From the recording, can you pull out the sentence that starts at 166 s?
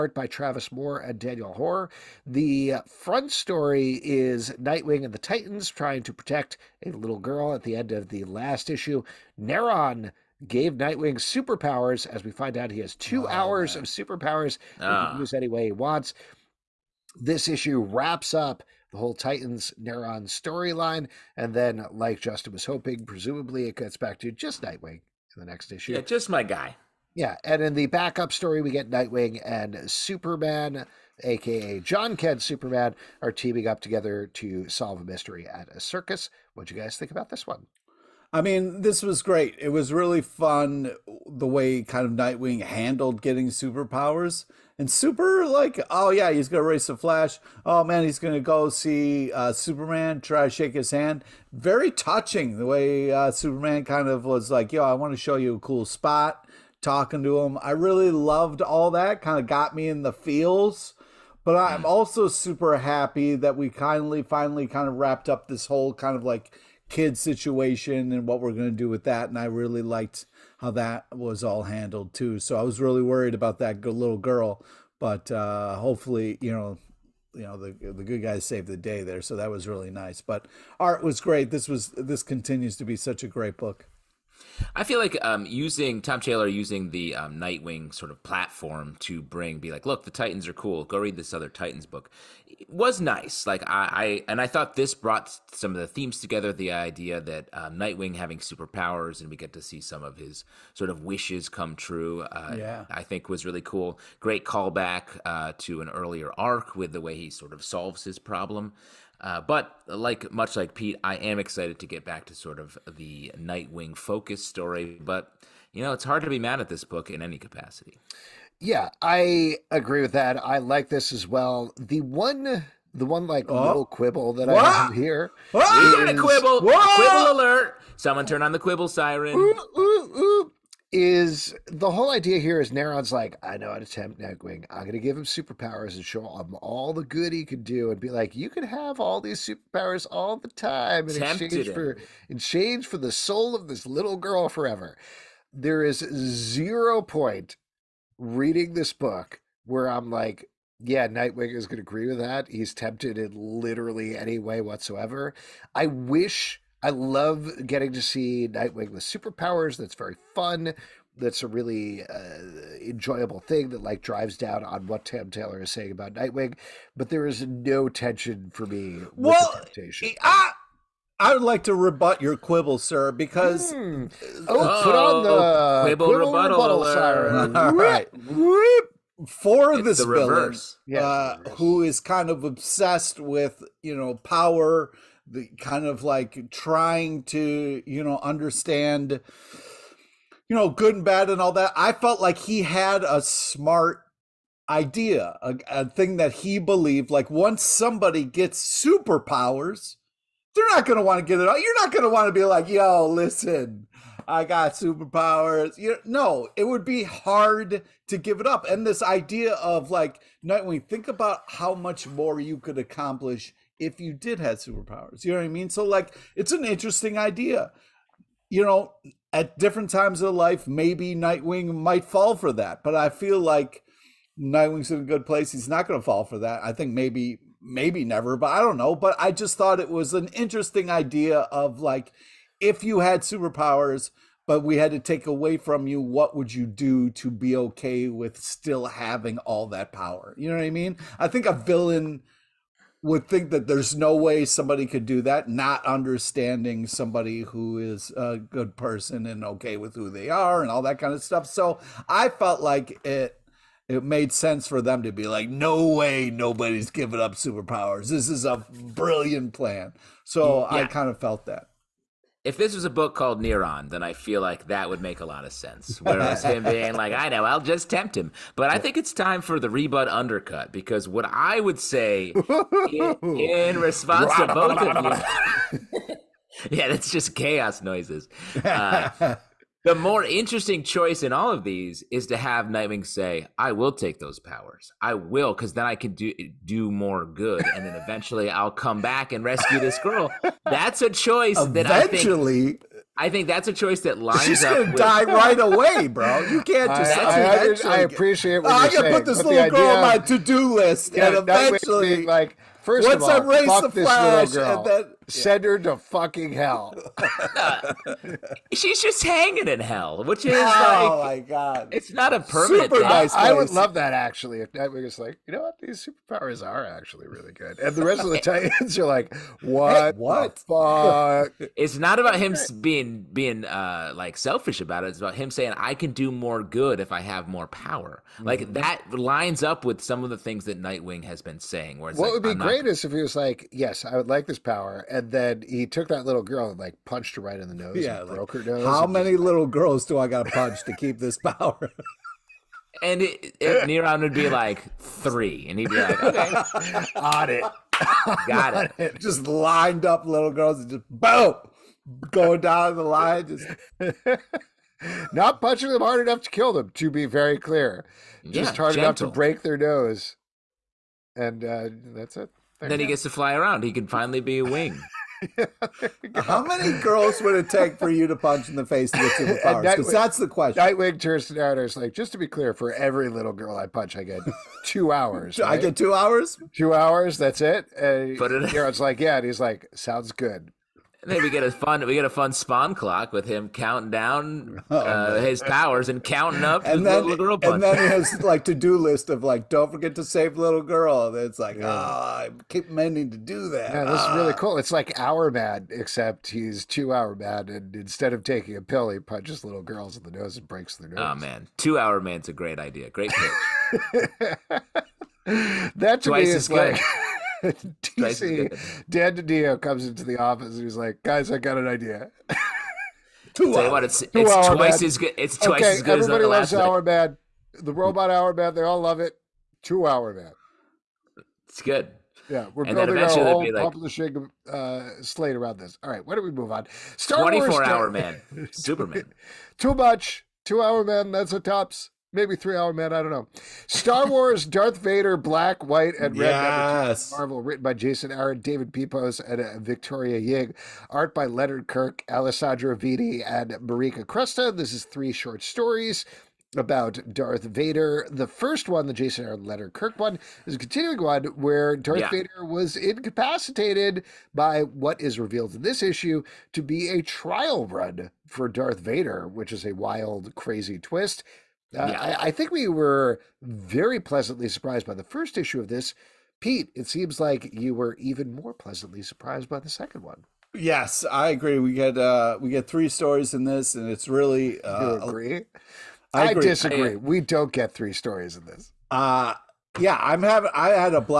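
But there is no tension for me.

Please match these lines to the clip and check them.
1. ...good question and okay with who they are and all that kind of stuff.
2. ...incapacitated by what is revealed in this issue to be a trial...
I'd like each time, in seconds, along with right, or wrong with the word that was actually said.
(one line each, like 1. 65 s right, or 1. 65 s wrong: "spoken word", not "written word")
1. 248 s wrong: "person", not "question"
2. 452 s right.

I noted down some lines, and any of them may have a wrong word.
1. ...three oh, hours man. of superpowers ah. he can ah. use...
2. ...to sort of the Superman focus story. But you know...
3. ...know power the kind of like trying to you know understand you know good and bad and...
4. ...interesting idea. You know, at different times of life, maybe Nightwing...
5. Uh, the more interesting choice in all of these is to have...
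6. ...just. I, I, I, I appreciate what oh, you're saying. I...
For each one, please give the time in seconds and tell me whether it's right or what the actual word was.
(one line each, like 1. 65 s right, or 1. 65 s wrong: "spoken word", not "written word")
1. 12 s wrong: "two", not "three"
2. 112 s wrong: "Nightwing", not "Superman"
3. 183 s right
4. 216 s right
5. 278 s right
6. 296 s right.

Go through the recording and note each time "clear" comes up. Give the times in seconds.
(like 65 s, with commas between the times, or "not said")
357 s, 372 s.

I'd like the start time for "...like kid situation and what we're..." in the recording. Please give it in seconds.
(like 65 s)
66 s.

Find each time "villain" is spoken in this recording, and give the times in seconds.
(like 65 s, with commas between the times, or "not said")
180 s, 241 s.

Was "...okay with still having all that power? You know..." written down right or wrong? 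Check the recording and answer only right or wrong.
right.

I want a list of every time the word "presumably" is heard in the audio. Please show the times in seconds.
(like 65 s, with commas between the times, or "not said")
23 s.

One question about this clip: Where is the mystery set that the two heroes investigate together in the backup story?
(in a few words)
A circus.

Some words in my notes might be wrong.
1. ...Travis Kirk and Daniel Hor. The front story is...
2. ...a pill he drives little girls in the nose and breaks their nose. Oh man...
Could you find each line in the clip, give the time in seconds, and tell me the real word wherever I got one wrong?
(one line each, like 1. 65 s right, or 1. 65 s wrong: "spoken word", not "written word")
1. 0 s wrong: "Moore", not "Kirk"
2. 398 s wrong: "punches", not "drives".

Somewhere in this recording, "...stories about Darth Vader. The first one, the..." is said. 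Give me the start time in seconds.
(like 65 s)
445 s.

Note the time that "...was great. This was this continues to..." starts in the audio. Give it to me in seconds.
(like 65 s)
81 s.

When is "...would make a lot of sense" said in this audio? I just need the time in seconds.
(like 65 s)
264 s.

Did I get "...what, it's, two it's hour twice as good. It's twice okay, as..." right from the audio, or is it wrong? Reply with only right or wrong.
right.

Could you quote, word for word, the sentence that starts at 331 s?
Where what like, would be I'm great not...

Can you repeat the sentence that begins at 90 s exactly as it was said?
Go read this other Titans book.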